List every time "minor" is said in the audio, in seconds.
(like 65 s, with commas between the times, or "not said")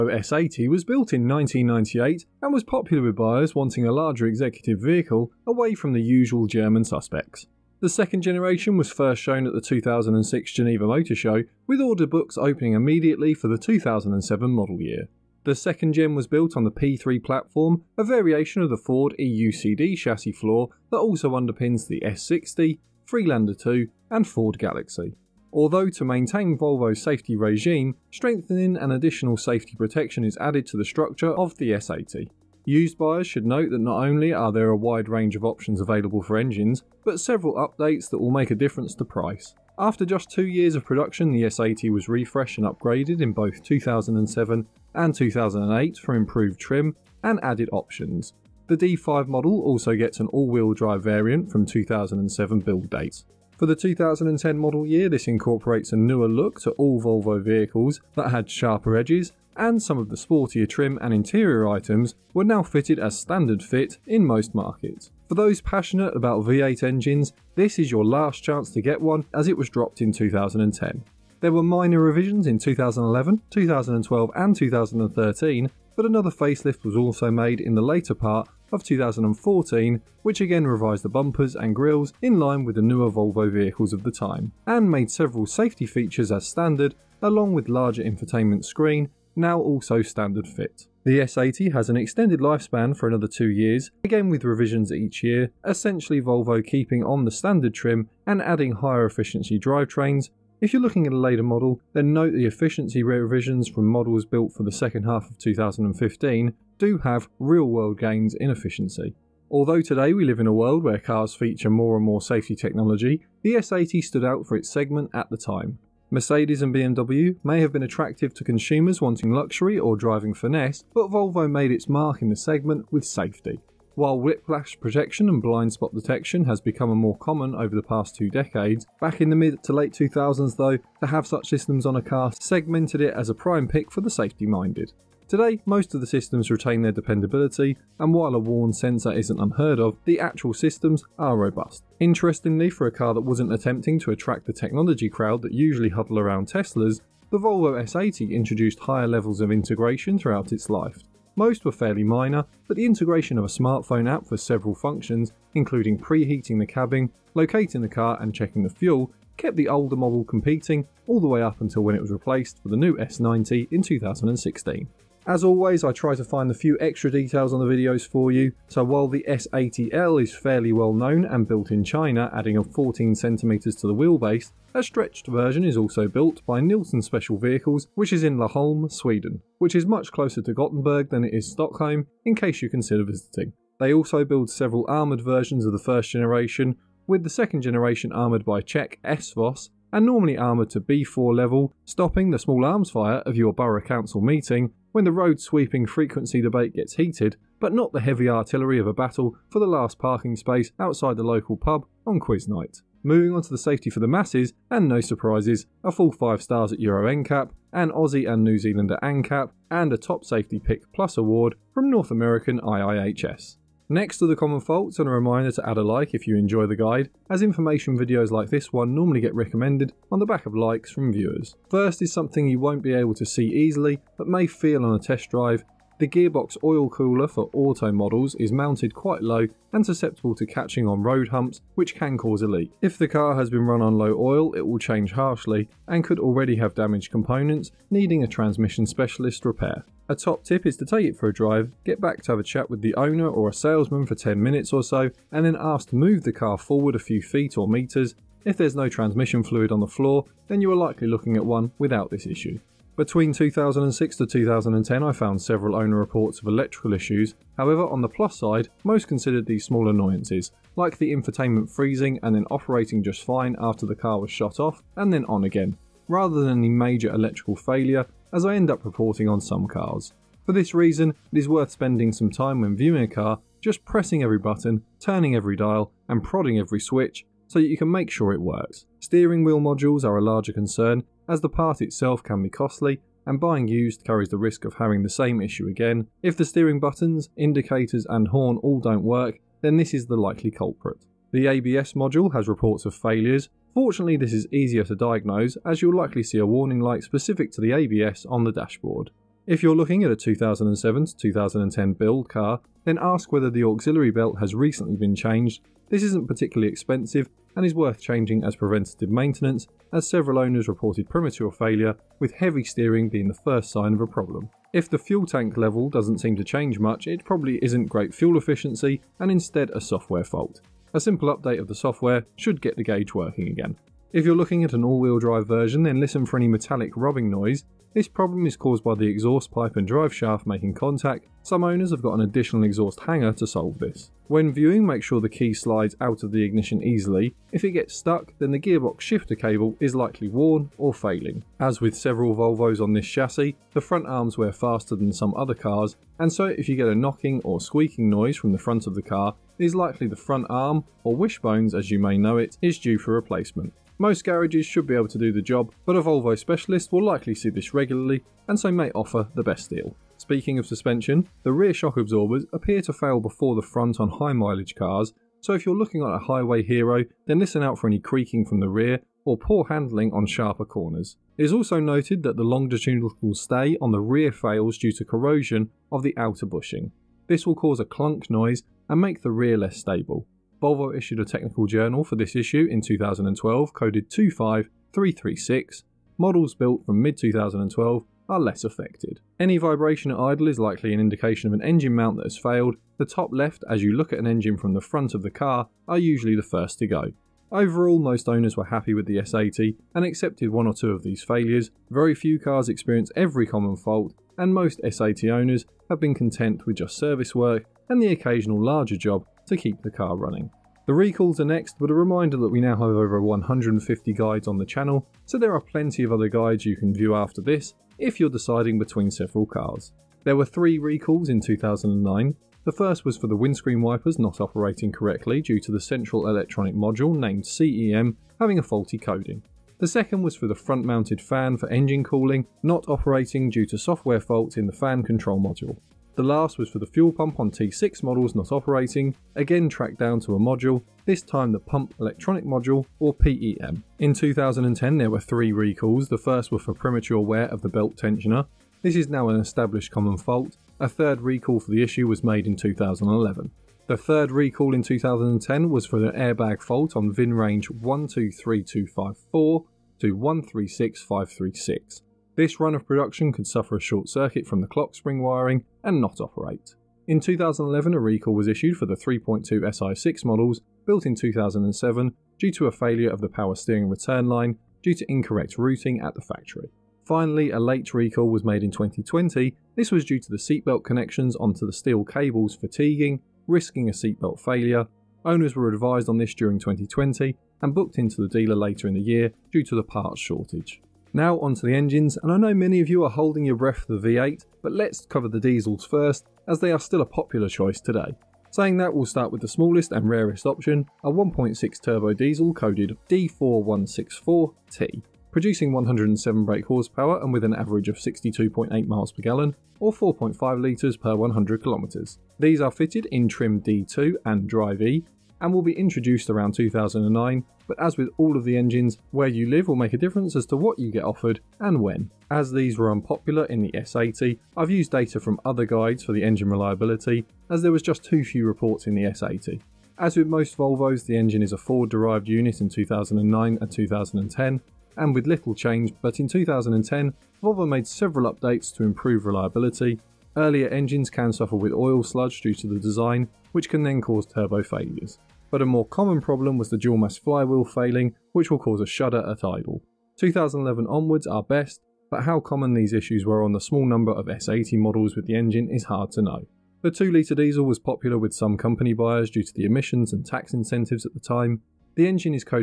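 71 s, 152 s.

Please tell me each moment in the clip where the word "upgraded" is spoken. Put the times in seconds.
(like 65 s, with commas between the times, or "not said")
42 s.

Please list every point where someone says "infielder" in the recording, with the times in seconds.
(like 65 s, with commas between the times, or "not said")
not said.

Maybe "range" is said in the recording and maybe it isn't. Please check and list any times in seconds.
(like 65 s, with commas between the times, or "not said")
35 s, 457 s.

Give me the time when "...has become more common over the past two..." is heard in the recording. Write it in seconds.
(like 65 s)
126 s.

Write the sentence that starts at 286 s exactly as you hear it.
If the steering buttons, indicators, and horn all don't work, then this is the likely culprit.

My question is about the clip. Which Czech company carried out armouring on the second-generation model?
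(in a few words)
SVOS.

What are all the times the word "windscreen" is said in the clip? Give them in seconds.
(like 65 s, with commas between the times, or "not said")
423 s.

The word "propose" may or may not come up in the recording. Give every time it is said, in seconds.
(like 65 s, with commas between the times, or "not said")
not said.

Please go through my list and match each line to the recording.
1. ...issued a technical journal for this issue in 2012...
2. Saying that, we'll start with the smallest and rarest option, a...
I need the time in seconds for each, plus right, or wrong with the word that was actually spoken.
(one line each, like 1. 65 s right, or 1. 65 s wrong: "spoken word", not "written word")
1. 380 s right
2. 498 s right.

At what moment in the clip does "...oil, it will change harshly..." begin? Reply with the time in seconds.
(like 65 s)
234 s.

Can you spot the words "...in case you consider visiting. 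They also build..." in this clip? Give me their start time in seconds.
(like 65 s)
182 s.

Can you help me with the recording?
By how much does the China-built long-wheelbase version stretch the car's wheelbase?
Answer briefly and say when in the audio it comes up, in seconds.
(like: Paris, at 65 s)
14cm, at 172 s.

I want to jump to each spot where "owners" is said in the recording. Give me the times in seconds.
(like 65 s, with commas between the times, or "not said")
242 s, 255 s, 310 s, 331 s, 398 s, 405 s, 485 s.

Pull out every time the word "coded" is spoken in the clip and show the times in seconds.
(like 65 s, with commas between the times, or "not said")
383 s, 502 s.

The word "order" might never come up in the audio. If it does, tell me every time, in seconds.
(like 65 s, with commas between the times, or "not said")
11 s.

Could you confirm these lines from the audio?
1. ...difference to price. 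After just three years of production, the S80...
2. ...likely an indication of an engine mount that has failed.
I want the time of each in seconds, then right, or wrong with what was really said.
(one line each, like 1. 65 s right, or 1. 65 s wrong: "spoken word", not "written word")
1. 38 s wrong: "two", not "three"
2. 390 s right.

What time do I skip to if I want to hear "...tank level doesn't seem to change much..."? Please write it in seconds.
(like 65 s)
315 s.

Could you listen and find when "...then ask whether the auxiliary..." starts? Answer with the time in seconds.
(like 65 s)
302 s.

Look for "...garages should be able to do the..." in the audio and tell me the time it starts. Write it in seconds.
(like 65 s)
354 s.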